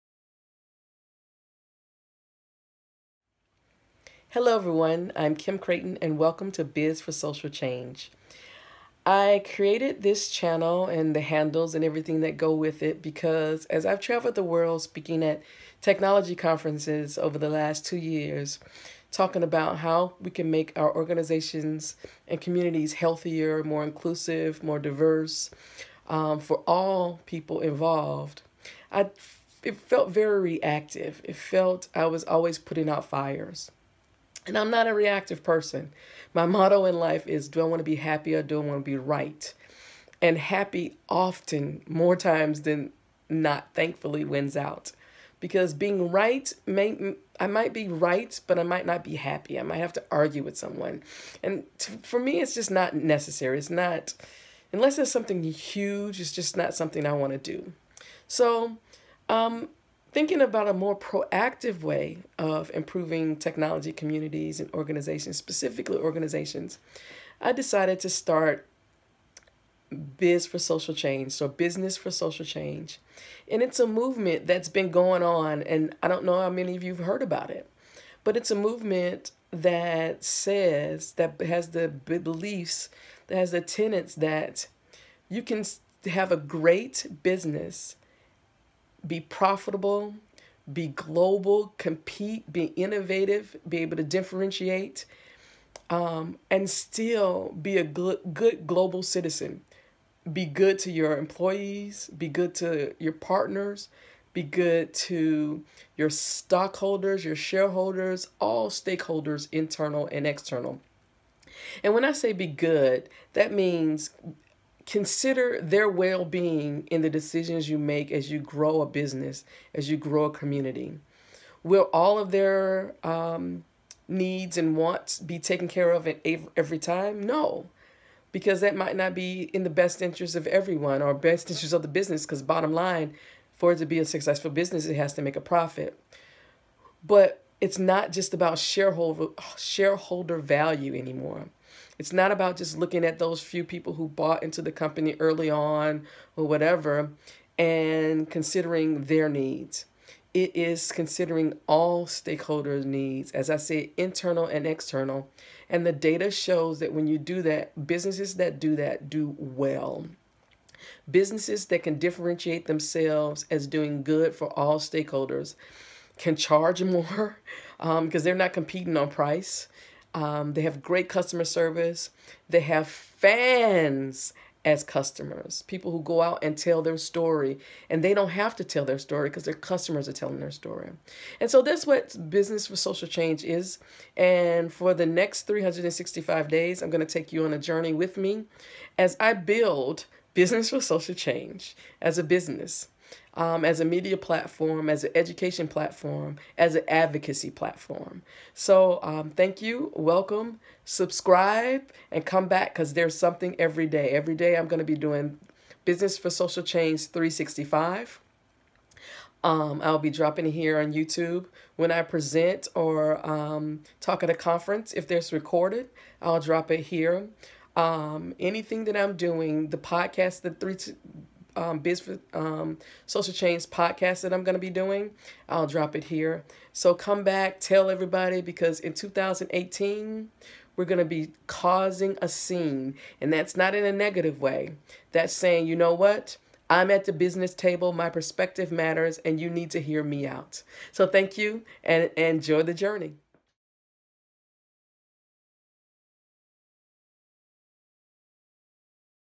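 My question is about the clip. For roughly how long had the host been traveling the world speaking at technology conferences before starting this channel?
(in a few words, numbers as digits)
2 years.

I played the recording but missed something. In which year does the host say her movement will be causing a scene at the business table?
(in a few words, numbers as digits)
2018.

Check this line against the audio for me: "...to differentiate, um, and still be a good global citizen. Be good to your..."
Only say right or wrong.
right.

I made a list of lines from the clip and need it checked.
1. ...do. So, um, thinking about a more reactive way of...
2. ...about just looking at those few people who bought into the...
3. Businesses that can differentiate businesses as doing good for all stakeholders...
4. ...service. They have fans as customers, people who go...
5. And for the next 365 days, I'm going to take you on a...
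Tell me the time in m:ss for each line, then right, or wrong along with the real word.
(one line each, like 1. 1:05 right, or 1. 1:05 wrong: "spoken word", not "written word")
1. 0:57 wrong: "proactive", not "reactive"
2. 2:22 right
3. 2:41 wrong: "themselves", not "businesses"
4. 2:51 right
5. 3:04 right.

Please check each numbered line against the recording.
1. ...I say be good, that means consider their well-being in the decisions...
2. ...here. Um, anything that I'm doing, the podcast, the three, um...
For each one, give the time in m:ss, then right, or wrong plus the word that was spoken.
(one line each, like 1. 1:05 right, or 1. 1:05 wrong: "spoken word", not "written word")
1. 1:52 right
2. 3:36 right.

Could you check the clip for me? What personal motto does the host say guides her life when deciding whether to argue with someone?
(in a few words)
Do I want to be happy or do I want to be right?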